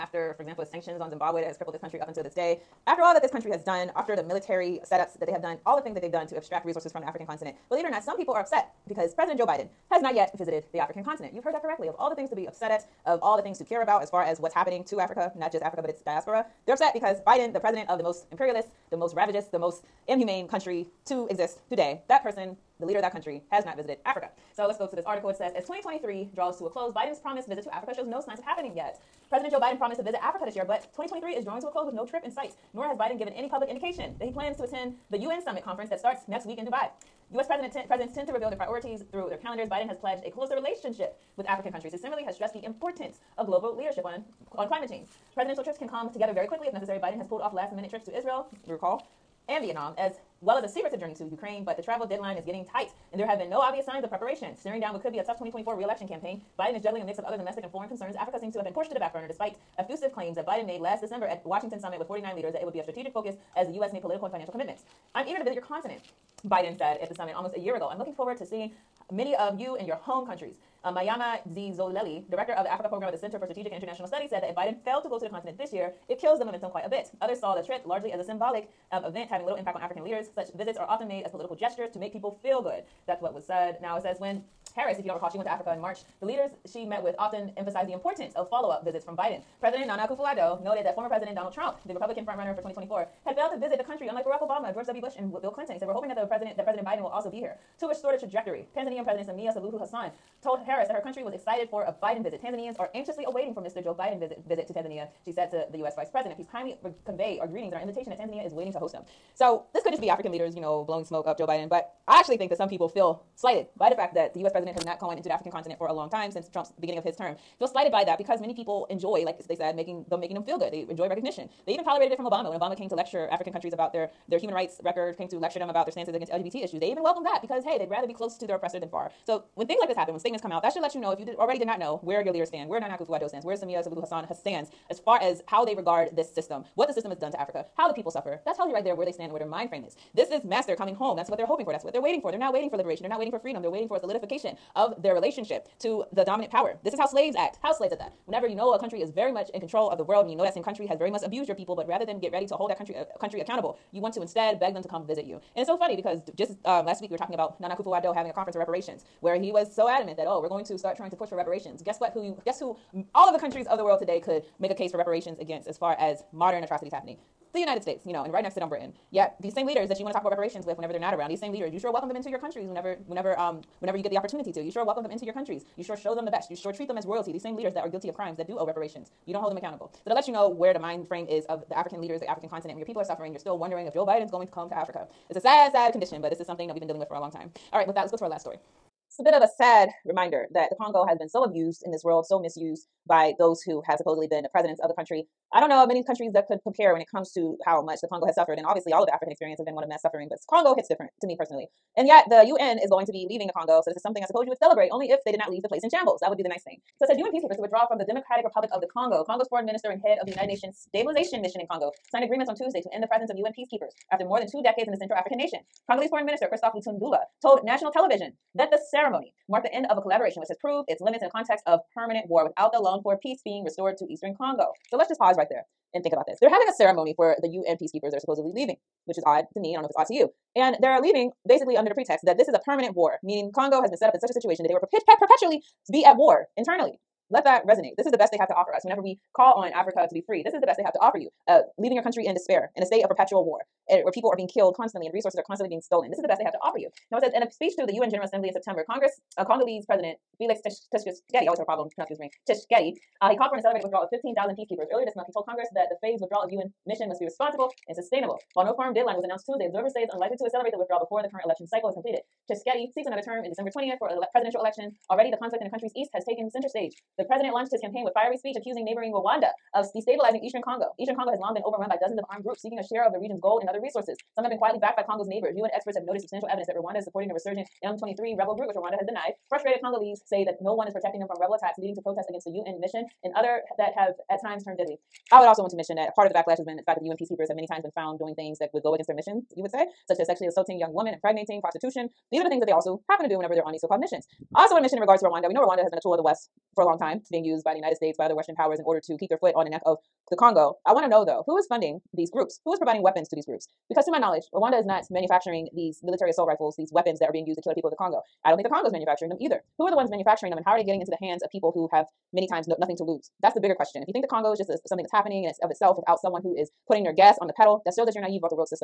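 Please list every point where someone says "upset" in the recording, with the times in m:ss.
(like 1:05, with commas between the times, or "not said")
0:08, 0:12, 0:16.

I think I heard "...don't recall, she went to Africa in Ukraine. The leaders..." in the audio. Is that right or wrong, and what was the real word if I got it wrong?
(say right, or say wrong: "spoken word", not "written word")
wrong: "March", not "Ukraine".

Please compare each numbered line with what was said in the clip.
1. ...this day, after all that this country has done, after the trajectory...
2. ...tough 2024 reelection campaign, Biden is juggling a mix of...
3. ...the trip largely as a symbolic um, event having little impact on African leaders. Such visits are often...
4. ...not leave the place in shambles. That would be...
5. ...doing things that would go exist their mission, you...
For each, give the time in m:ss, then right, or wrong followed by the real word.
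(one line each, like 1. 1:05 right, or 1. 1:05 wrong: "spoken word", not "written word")
1. 0:02 wrong: "military", not "trajectory"
2. 0:55 right
3. 1:17 right
4. 3:25 right
5. 4:48 wrong: "against", not "exist".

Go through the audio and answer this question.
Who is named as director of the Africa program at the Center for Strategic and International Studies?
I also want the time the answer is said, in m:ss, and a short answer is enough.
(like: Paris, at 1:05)
Mvemba Dizolele, at 1:10.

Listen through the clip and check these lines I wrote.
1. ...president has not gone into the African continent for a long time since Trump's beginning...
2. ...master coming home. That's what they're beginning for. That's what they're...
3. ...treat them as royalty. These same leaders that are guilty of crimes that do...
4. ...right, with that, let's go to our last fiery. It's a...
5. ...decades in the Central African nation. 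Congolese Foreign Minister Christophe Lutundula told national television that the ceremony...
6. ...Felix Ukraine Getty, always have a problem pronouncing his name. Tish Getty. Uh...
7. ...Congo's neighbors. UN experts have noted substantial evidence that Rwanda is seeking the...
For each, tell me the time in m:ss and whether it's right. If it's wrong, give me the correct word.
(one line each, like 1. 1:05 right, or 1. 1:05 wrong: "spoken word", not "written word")
1. 1:54 right
2. 2:20 wrong: "hoping", not "beginning"
3. 2:56 right
4. 3:07 wrong: "story", not "fiery"
5. 3:34 right
6. 4:10 wrong: "Tshisekedi", not "Ukraine"
7. 4:35 wrong: "supporting", not "seeking".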